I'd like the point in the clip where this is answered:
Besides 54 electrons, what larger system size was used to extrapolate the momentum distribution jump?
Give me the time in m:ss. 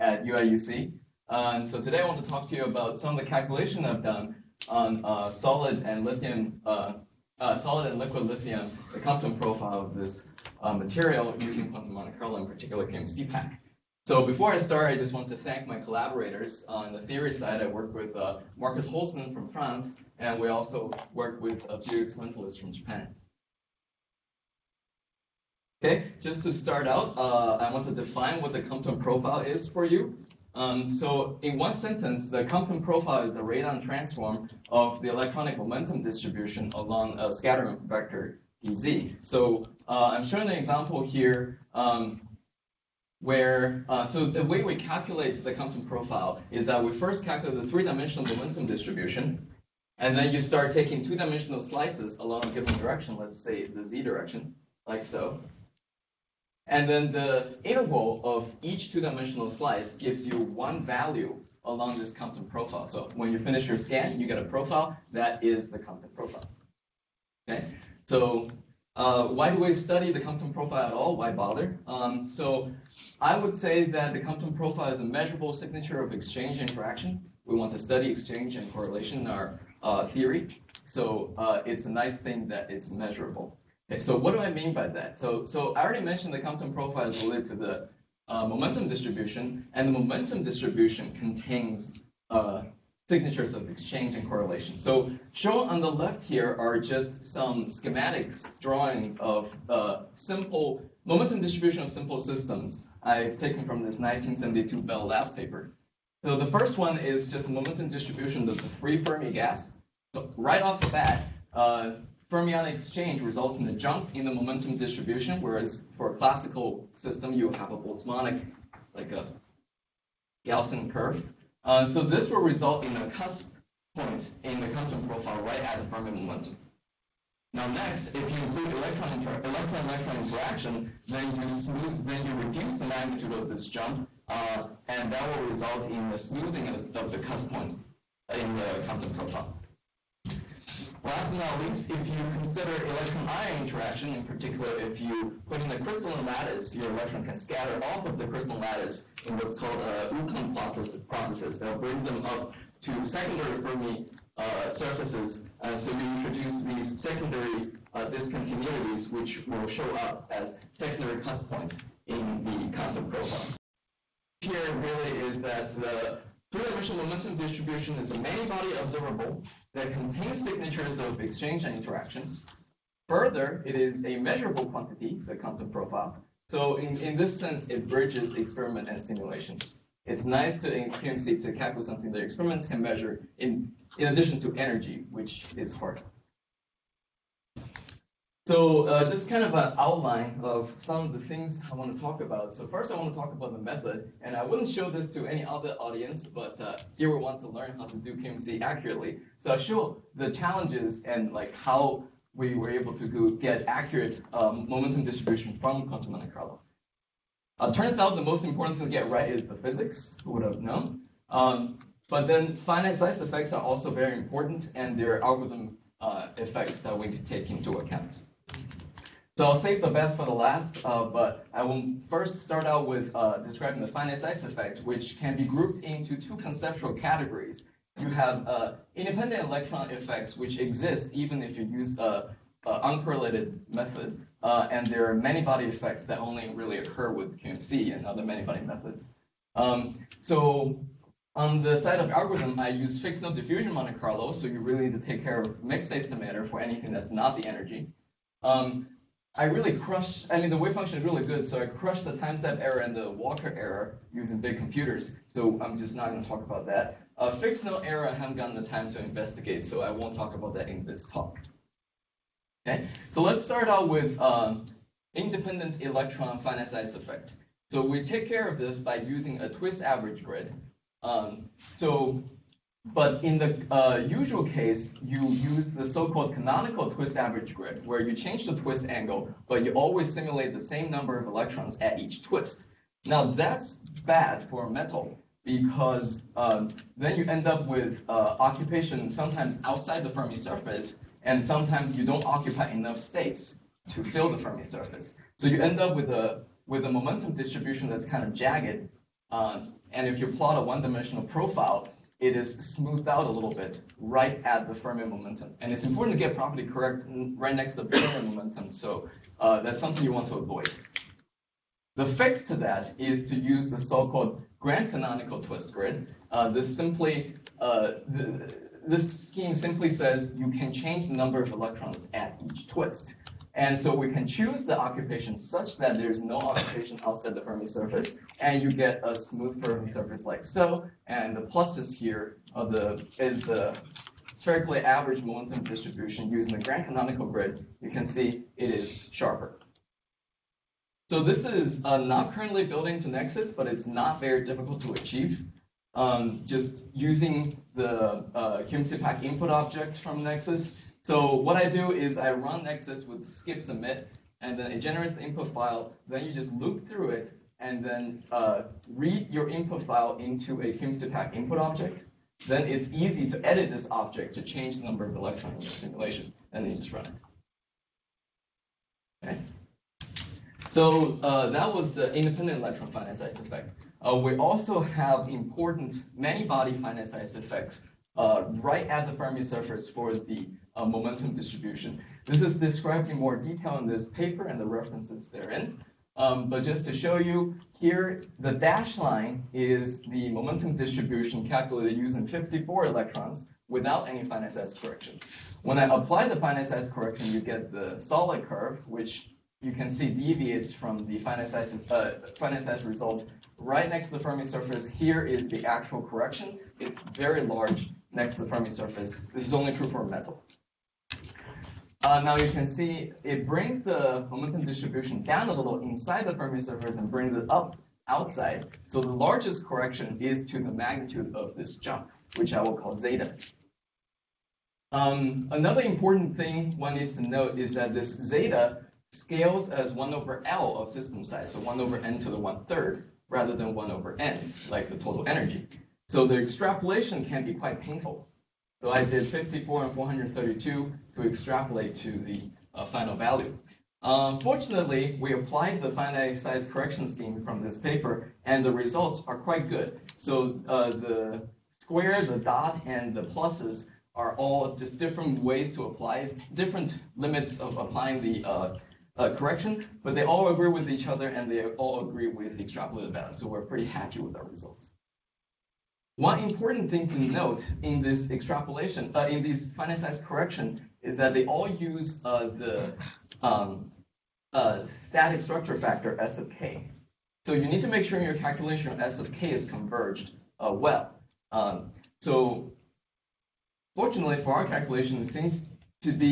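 7:19.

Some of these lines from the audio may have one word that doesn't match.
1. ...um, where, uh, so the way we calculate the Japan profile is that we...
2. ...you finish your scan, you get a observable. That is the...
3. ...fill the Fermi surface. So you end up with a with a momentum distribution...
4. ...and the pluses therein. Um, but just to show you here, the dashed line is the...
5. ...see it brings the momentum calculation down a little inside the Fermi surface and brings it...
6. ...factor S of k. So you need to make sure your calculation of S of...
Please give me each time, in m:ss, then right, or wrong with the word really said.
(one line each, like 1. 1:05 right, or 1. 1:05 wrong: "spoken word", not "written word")
1. 0:41 wrong: "Compton", not "Japan"
2. 1:03 wrong: "profile", not "observable"
3. 4:54 right
4. 6:24 wrong: "references", not "pluses"
5. 6:52 wrong: "distribution", not "calculation"
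6. 7:55 right.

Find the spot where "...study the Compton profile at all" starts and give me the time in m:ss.
1:09.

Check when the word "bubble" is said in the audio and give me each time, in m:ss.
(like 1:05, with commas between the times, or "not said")
not said.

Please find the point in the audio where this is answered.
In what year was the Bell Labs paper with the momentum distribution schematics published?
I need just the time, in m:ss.
1:43.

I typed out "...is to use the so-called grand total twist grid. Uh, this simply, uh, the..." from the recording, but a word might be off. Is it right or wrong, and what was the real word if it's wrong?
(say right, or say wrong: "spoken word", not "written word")
wrong: "canonical", not "total".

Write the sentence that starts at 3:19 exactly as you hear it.
So I'll show the challenges and like how we were able to get accurate um, momentum distribution from quantum Monte Carlo.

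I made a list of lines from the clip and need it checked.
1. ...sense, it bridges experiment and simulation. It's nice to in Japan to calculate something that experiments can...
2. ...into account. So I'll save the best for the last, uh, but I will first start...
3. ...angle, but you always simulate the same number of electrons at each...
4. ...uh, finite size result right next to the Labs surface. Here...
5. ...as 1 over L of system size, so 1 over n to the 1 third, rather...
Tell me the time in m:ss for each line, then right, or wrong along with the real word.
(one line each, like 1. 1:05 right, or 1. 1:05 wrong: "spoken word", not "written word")
1. 2:57 wrong: "QMC", not "Japan"
2. 3:37 right
3. 4:38 right
4. 6:41 wrong: "Fermi", not "Labs"
5. 7:09 right.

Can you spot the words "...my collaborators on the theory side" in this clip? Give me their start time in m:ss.
0:15.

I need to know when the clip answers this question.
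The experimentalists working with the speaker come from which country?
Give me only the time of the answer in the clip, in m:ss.
0:22.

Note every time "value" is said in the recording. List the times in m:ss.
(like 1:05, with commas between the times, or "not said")
1:00, 7:23, 7:43.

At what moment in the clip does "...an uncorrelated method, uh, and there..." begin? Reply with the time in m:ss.
3:51.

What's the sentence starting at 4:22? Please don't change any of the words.
Okay, so let's start out with um, independent electron finite size effect.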